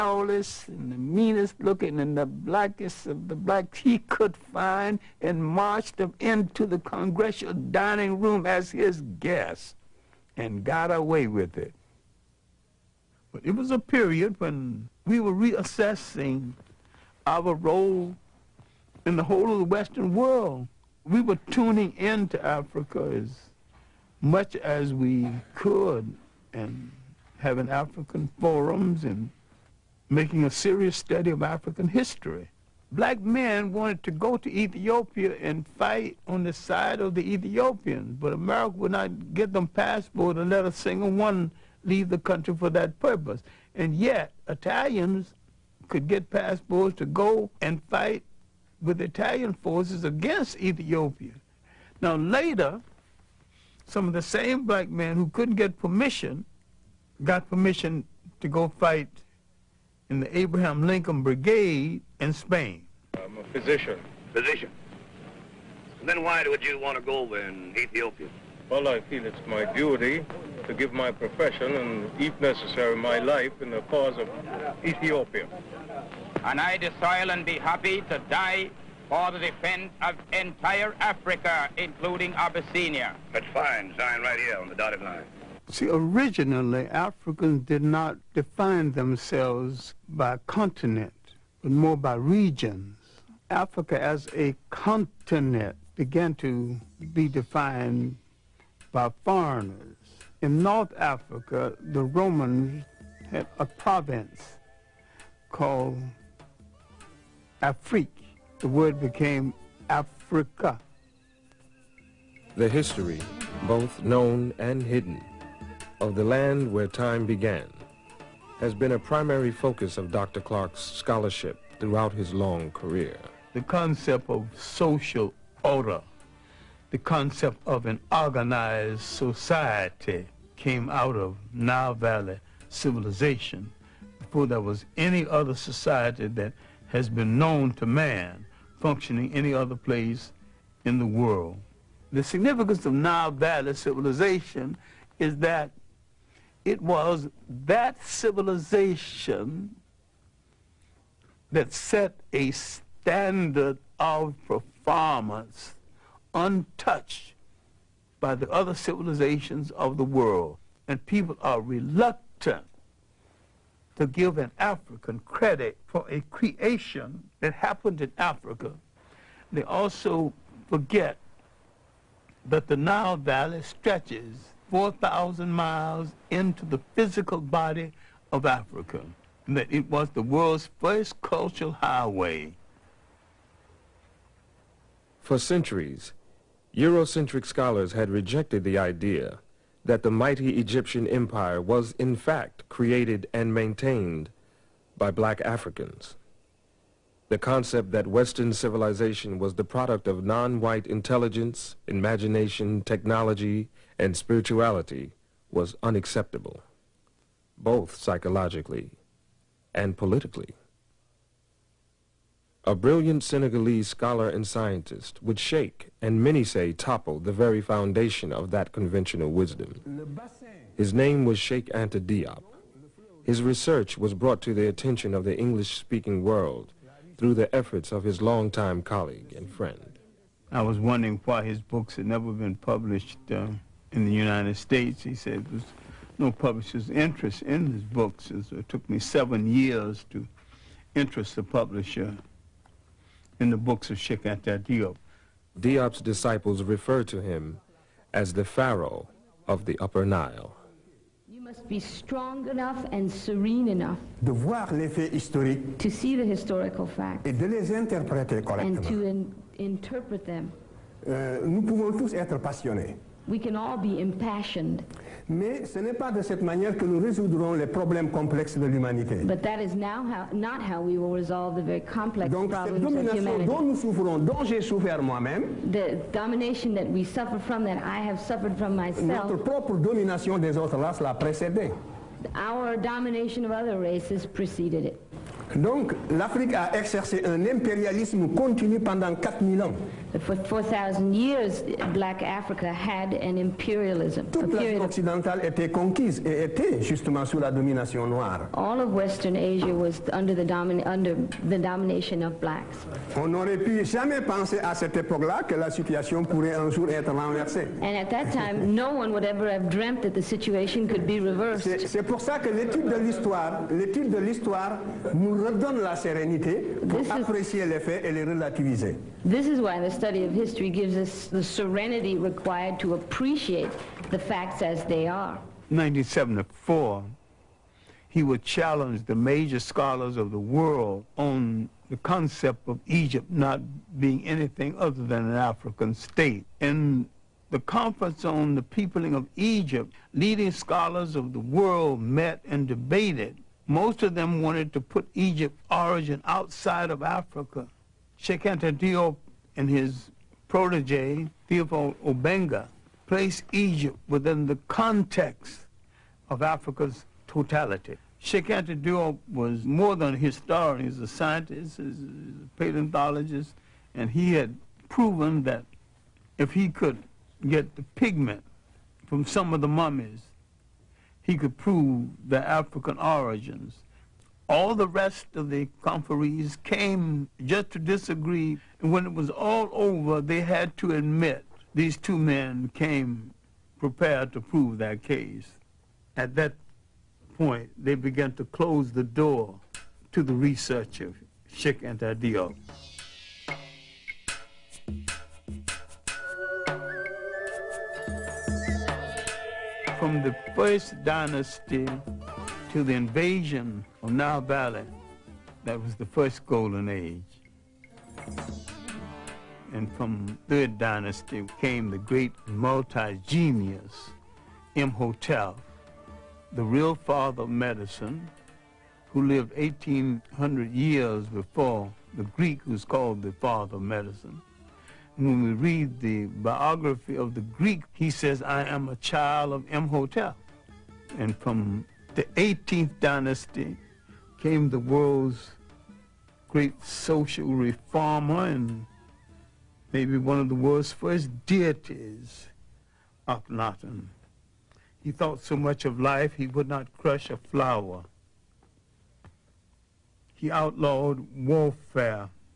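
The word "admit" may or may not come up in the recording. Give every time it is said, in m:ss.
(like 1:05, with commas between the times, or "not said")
6:20.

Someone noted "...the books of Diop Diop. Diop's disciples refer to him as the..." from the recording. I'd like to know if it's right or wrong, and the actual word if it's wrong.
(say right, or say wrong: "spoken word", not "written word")
wrong: "Sheikh", not "Diop".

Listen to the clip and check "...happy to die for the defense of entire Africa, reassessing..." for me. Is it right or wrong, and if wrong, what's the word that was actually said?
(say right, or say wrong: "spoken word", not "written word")
wrong: "including", not "reassessing".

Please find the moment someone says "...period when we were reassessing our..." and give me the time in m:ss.
0:13.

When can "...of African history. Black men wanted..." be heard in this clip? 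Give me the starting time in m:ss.
0:31.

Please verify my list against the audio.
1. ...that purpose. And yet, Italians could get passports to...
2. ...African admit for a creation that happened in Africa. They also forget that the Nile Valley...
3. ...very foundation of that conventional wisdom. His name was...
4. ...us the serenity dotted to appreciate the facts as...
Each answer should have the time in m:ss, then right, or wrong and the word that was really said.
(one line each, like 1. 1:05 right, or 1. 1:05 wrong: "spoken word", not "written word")
1. 0:42 right
2. 2:44 wrong: "credit", not "admit"
3. 3:37 right
4. 5:20 wrong: "required", not "dotted".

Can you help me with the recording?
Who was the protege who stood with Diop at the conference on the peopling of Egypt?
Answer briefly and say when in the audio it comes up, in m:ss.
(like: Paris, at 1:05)
Theophile Obenga, at 5:51.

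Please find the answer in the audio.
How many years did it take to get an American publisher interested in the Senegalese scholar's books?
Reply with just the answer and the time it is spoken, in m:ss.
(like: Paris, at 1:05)
seven years, at 3:58.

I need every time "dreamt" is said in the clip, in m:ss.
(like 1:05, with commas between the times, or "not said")
5:09.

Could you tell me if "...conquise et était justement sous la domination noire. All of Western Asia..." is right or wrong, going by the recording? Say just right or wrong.
right.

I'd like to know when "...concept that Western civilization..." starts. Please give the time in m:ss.
3:17.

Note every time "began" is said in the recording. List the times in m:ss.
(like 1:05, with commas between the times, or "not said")
1:35, 1:57, 6:27.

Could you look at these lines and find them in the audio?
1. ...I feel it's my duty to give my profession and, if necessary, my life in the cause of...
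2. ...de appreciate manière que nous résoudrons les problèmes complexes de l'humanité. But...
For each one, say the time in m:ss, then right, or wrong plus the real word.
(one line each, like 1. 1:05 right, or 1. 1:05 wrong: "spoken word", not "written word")
1. 1:08 right
2. 4:26 wrong: "cette", not "appreciate".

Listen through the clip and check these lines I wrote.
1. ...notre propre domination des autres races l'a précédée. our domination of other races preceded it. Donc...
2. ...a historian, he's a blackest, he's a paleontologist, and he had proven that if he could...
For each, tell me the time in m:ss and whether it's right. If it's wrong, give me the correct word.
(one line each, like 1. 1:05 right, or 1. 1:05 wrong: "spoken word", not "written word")
1. 4:39 right
2. 6:00 wrong: "scientist", not "blackest".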